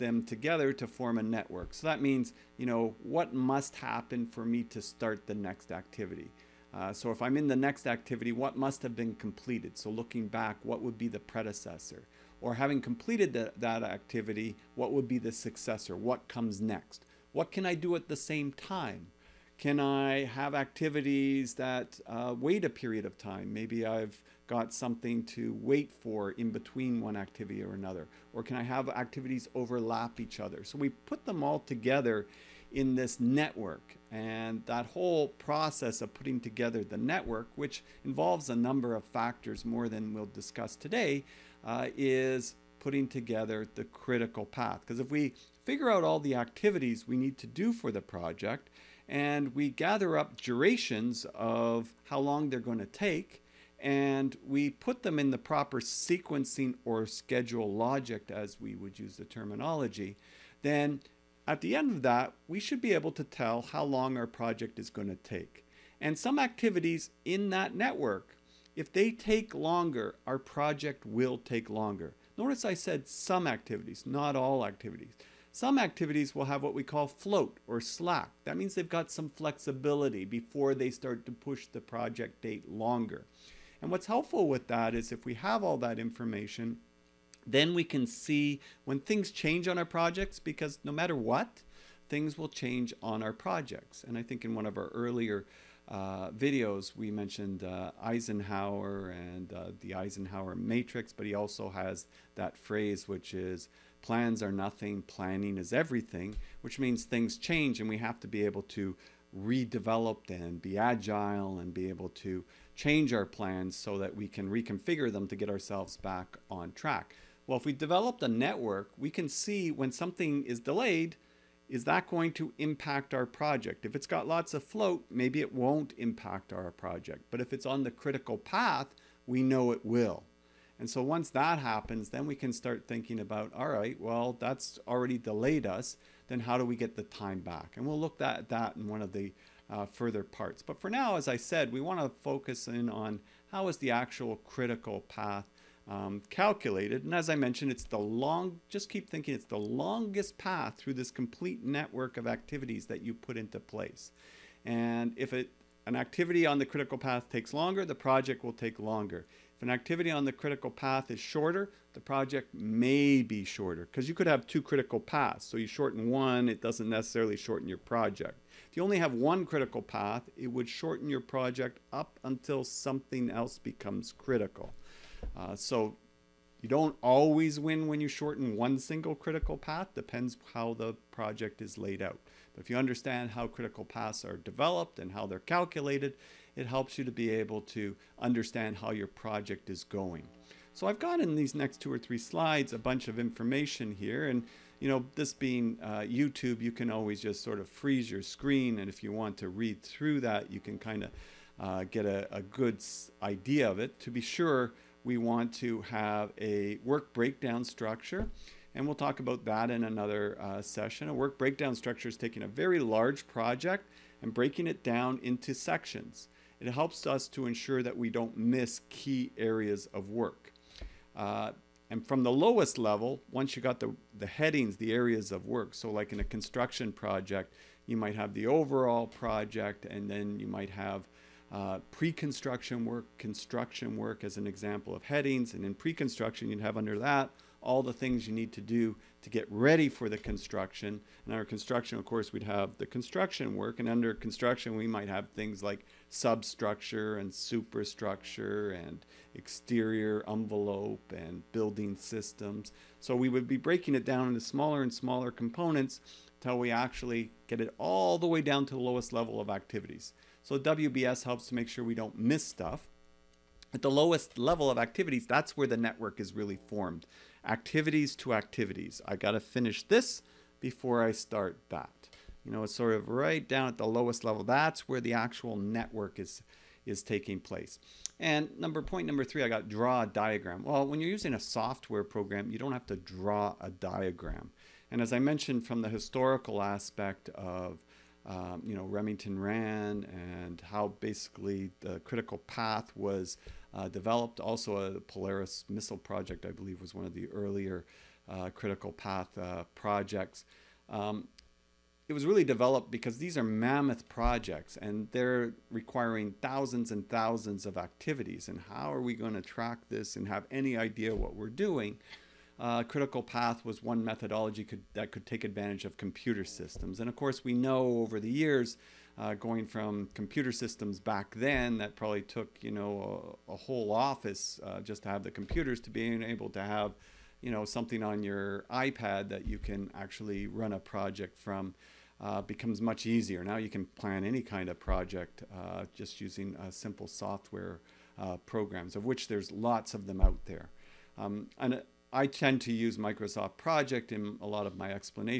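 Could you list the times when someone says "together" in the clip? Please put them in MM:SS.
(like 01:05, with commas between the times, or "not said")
00:00, 00:31, 00:36, 00:43.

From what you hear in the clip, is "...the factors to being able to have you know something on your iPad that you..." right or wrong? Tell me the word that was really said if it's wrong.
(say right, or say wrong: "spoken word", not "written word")
wrong: "computers", not "factors".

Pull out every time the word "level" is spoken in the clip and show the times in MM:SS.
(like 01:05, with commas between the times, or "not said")
03:42, 04:19, 04:24, 04:34.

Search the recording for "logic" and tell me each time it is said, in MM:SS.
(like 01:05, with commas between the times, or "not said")
00:57.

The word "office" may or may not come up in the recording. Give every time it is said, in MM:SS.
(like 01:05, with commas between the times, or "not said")
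05:23.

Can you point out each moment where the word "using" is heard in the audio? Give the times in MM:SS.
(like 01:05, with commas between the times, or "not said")
04:41, 05:36.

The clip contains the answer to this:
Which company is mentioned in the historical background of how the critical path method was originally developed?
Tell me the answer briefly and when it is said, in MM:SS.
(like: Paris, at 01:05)
Remington Rand, at 04:48.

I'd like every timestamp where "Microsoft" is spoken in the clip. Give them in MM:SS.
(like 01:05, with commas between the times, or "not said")
05:42.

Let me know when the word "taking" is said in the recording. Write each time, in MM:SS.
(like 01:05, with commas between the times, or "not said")
03:32, 04:37.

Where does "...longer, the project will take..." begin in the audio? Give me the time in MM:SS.
02:37.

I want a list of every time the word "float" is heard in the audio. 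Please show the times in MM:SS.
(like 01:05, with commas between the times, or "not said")
01:17, 02:04.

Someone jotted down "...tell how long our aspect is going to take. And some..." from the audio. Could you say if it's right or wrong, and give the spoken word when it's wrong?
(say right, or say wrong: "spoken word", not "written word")
wrong: "project", not "aspect".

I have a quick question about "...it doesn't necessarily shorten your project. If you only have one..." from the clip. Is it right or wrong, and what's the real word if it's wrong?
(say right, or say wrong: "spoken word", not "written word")
right.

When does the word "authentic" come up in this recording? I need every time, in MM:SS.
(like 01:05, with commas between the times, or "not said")
not said.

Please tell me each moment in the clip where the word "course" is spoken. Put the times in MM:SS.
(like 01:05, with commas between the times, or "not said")
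04:02, 05:17.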